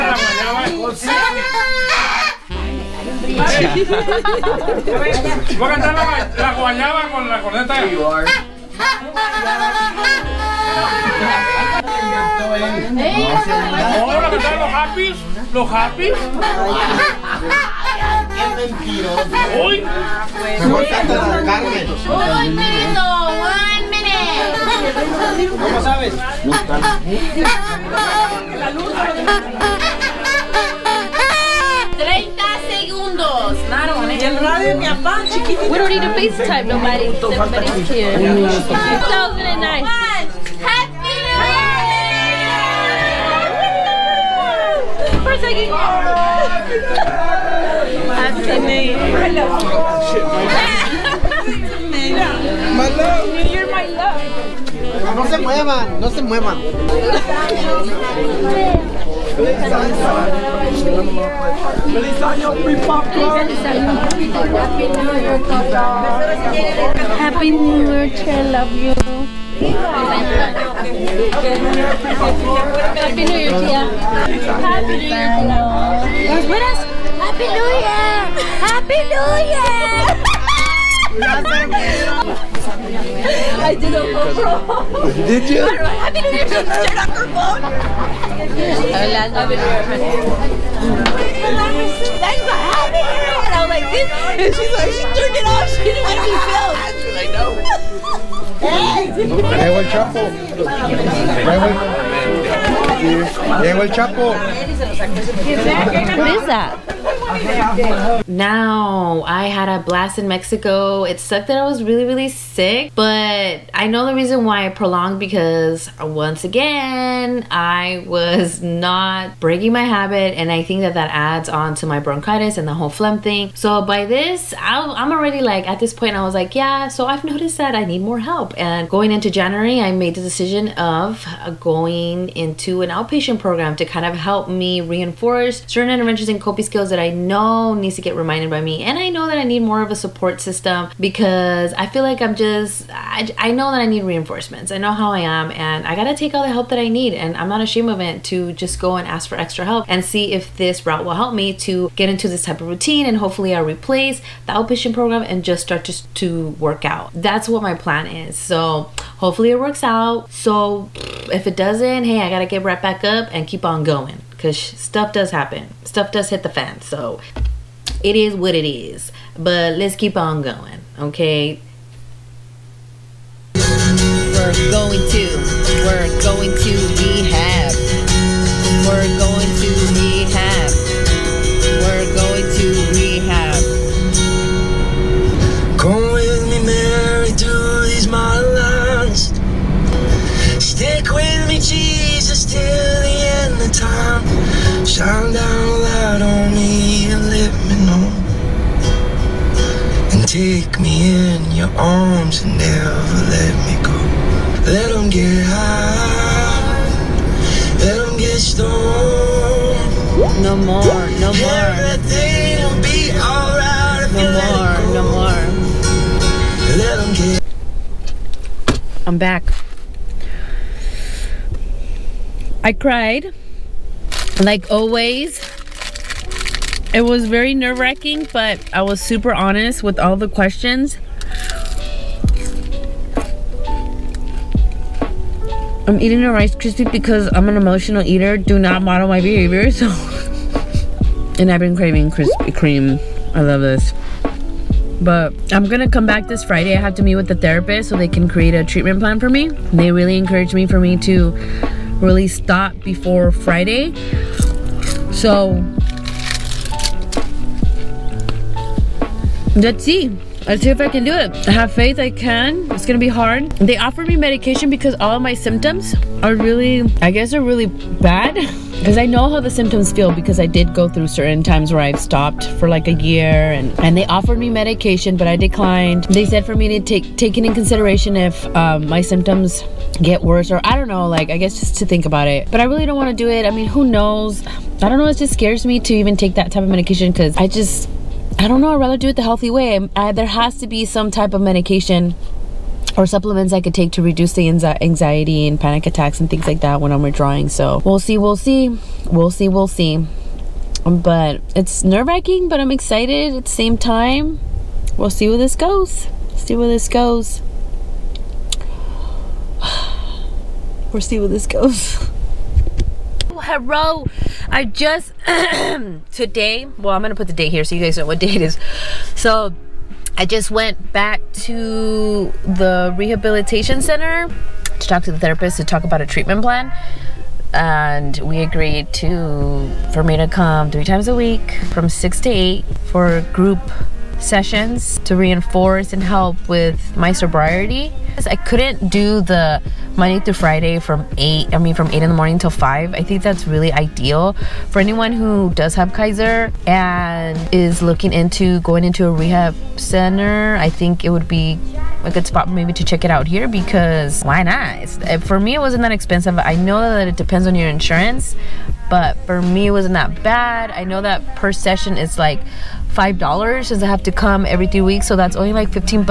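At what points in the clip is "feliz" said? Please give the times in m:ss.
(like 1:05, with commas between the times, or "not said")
1:01.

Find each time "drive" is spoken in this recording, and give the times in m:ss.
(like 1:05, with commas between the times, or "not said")
not said.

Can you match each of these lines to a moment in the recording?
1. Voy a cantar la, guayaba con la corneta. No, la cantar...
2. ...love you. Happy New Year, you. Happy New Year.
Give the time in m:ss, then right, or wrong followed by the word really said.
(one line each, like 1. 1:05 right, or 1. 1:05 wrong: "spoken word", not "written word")
1. 0:05 right
2. 1:08 right.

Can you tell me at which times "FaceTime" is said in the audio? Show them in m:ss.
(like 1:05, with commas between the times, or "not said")
0:36.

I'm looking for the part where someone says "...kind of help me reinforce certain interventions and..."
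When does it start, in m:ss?
2:13.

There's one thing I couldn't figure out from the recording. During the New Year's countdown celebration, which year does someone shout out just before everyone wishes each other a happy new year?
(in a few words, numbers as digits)
2009.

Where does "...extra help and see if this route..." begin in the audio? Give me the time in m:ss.
2:29.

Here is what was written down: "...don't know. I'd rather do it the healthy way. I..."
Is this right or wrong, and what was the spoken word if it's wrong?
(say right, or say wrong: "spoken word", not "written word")
right.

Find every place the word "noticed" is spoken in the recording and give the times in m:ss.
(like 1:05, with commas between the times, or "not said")
2:07.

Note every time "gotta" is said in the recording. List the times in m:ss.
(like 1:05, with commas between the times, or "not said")
2:25, 2:42.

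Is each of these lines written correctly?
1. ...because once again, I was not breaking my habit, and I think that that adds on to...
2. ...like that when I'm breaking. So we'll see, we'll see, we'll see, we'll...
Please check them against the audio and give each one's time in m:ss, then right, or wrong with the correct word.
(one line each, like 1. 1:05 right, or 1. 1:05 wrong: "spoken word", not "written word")
1. 1:55 right
2. 4:56 wrong: "withdrawing", not "breaking".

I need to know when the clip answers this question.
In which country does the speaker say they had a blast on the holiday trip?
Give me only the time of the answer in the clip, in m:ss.
1:50.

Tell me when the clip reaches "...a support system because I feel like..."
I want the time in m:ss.
2:19.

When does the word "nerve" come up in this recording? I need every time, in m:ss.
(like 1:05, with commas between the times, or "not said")
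3:47, 5:01.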